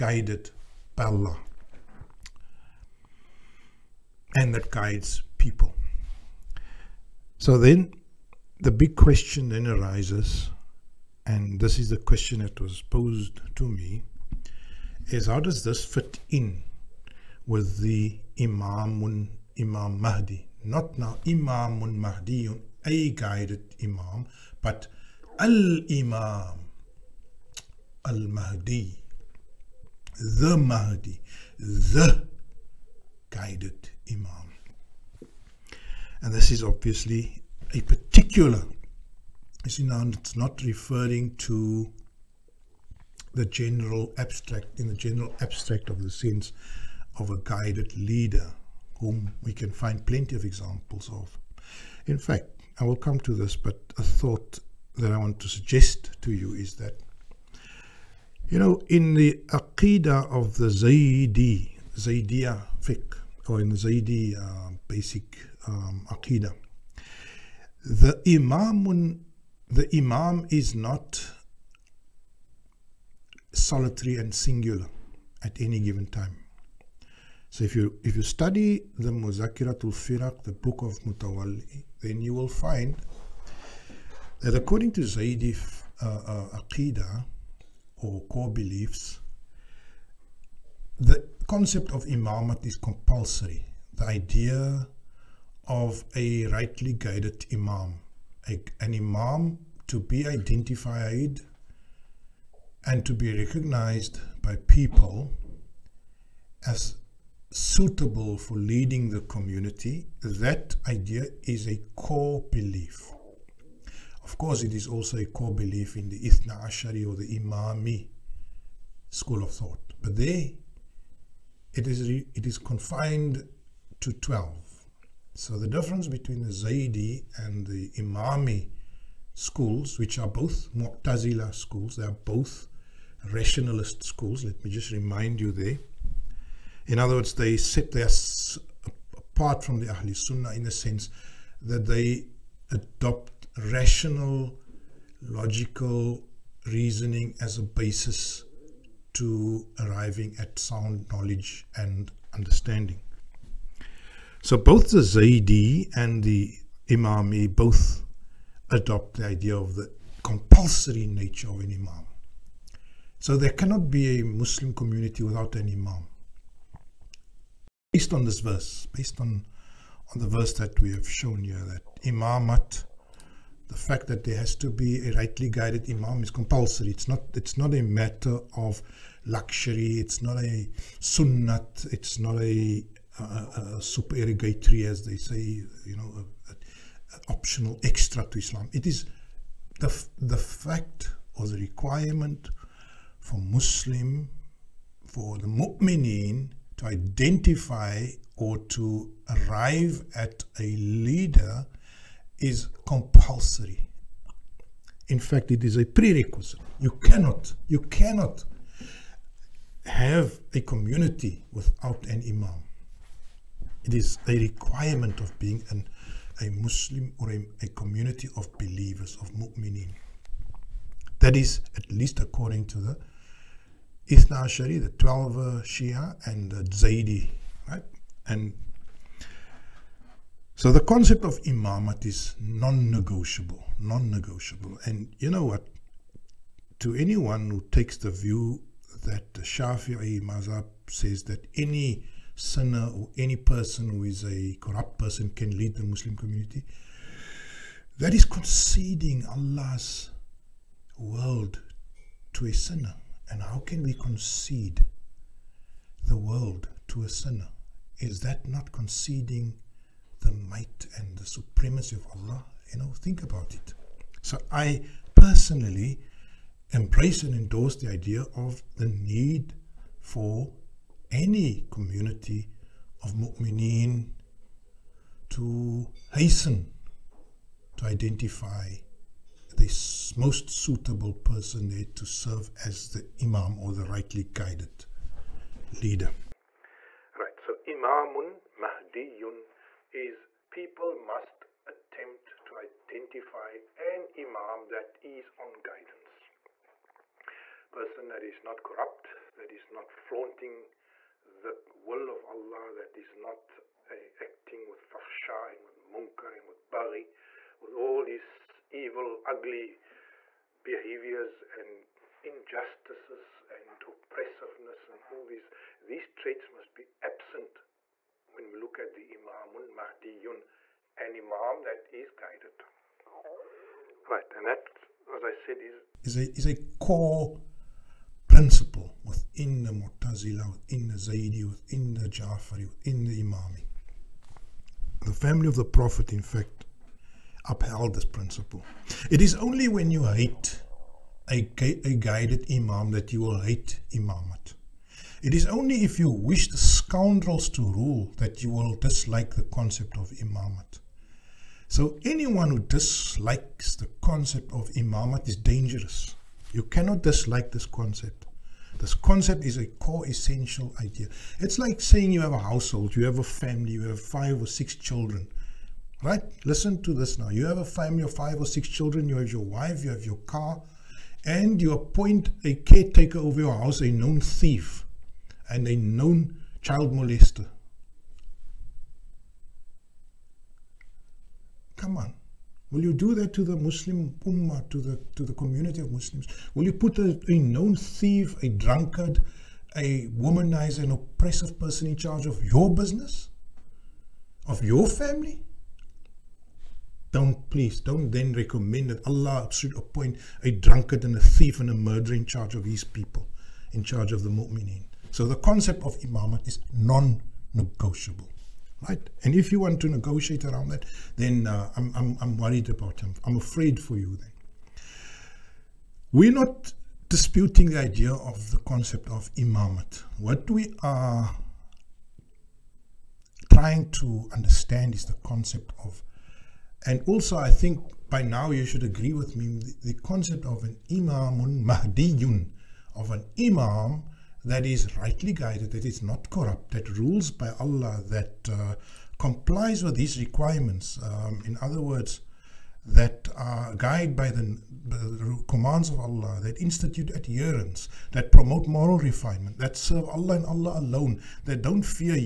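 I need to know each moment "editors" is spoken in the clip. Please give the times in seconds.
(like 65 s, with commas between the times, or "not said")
not said.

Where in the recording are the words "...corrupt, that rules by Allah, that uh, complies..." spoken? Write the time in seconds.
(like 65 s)
436 s.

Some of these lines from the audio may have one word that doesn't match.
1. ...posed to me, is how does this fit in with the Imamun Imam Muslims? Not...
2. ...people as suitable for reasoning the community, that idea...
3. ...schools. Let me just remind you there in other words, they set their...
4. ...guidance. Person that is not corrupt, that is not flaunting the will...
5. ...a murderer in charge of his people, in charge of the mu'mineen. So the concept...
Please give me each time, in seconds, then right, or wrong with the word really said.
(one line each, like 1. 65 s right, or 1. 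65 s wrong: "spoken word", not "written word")
1. 12 s wrong: "Mahdi", not "Muslims"
2. 104 s wrong: "leading", not "reasoning"
3. 134 s right
4. 295 s right
5. 401 s right.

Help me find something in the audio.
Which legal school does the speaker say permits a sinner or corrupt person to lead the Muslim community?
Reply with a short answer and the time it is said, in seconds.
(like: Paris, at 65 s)
Shafi'i, at 239 s.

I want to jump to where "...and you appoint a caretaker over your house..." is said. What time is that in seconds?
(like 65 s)
371 s.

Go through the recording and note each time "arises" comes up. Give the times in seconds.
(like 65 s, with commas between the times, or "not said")
9 s.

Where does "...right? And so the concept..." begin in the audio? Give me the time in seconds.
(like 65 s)
227 s.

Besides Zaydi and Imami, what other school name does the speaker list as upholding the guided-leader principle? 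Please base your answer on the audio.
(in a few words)
Ja'fari.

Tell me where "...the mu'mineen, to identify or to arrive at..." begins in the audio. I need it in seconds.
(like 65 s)
195 s.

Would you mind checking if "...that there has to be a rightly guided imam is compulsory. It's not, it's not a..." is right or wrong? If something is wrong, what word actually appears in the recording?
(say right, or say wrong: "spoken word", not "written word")
right.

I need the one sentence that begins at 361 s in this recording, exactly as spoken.
It's like saying you have a household, you have a family, you have five or six children.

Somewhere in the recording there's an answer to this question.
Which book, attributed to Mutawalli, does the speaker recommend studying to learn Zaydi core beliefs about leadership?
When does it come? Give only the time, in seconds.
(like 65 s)
79 s.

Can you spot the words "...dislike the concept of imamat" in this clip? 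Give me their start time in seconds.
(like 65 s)
348 s.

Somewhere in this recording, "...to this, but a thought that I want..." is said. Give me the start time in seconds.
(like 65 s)
53 s.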